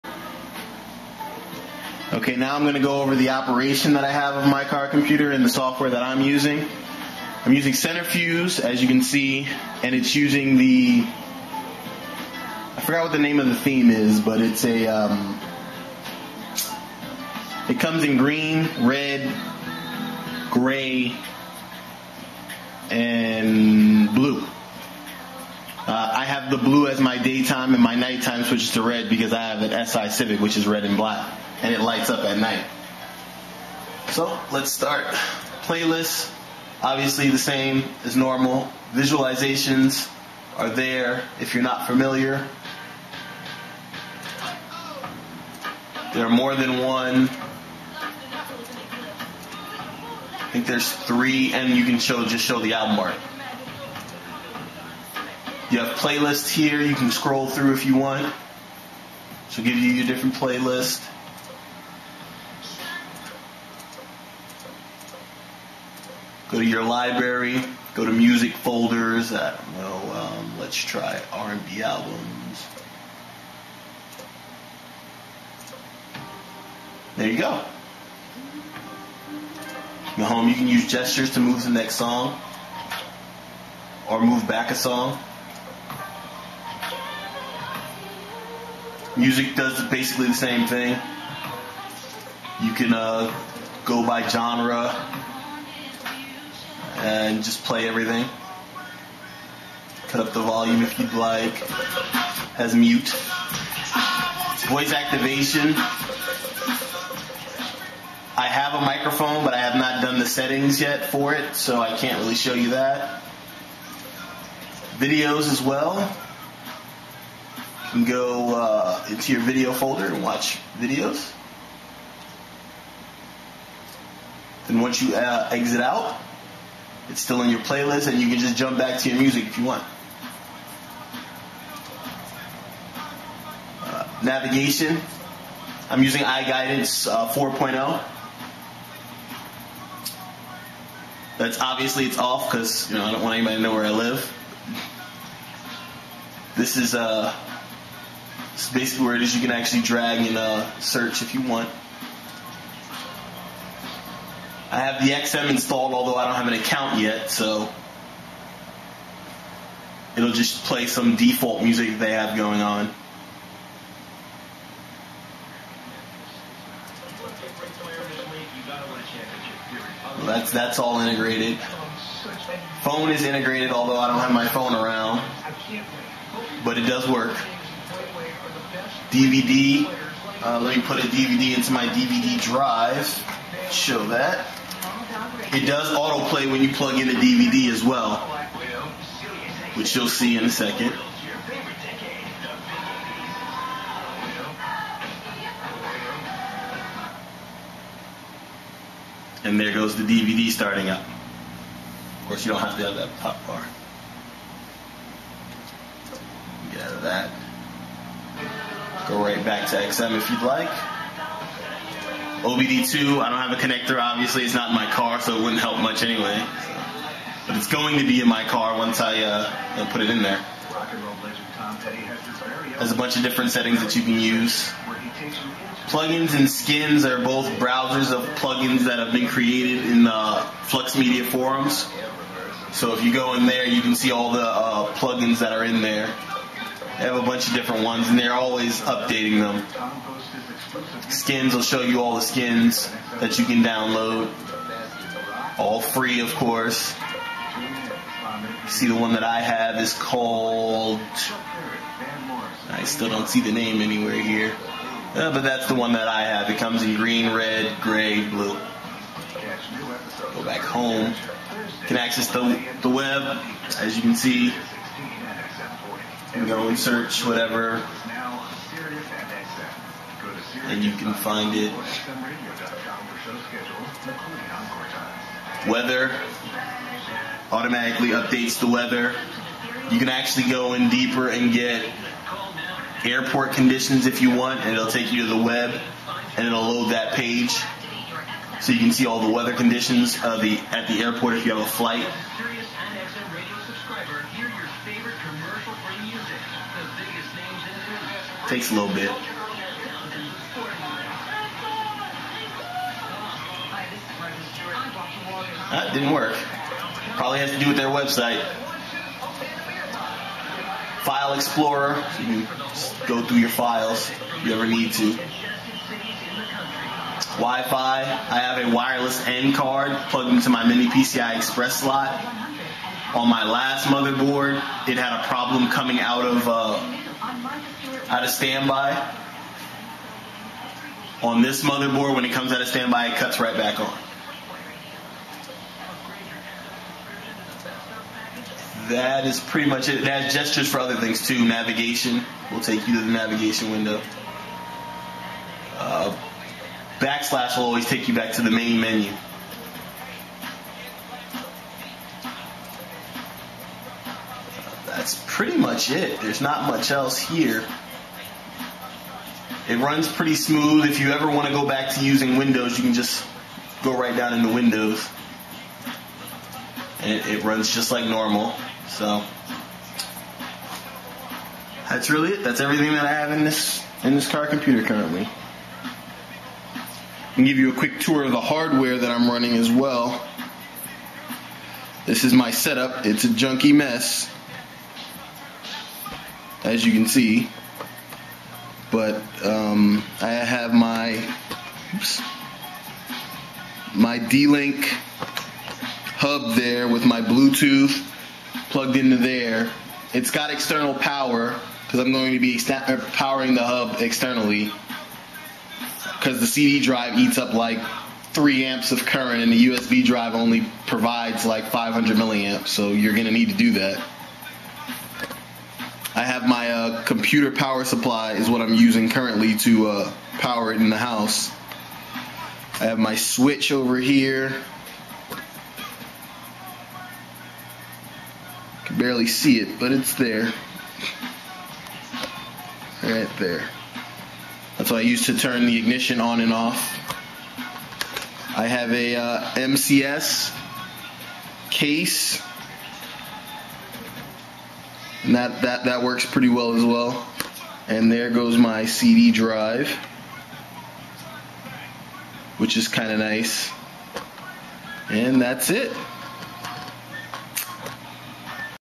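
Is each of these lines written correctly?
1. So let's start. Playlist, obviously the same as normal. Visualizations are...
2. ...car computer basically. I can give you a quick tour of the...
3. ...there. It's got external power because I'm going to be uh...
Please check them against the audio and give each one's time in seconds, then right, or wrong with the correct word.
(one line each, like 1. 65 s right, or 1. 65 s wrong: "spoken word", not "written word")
1. 34 s right
2. 374 s wrong: "currently", not "basically"
3. 399 s right.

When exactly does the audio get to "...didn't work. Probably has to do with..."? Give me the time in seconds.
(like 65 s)
305 s.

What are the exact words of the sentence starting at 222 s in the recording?
There's a bunch of different settings that you can use.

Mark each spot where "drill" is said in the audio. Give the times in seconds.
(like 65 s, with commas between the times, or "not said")
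not said.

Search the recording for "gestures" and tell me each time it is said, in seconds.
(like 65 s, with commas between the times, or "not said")
80 s, 340 s.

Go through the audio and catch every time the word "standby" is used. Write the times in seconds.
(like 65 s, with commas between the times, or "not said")
328 s, 332 s.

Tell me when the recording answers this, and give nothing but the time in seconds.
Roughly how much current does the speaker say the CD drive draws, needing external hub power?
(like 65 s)
408 s.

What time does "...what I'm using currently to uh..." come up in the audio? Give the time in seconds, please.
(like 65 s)
418 s.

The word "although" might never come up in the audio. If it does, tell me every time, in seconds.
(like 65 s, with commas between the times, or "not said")
155 s, 173 s.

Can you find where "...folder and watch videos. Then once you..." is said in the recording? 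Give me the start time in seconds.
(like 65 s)
119 s.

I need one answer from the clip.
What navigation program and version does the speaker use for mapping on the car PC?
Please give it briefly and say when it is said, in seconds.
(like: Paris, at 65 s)
iGuidance 4.0, at 136 s.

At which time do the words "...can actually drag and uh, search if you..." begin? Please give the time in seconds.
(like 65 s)
149 s.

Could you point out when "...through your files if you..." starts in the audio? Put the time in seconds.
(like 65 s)
313 s.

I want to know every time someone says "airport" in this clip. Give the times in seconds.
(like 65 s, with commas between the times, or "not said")
283 s, 291 s.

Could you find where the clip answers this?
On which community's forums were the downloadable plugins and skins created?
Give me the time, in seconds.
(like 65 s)
230 s.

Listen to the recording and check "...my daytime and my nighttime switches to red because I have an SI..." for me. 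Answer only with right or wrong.
right.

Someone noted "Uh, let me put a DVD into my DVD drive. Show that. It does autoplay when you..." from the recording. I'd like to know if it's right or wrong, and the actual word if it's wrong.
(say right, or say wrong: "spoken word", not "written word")
right.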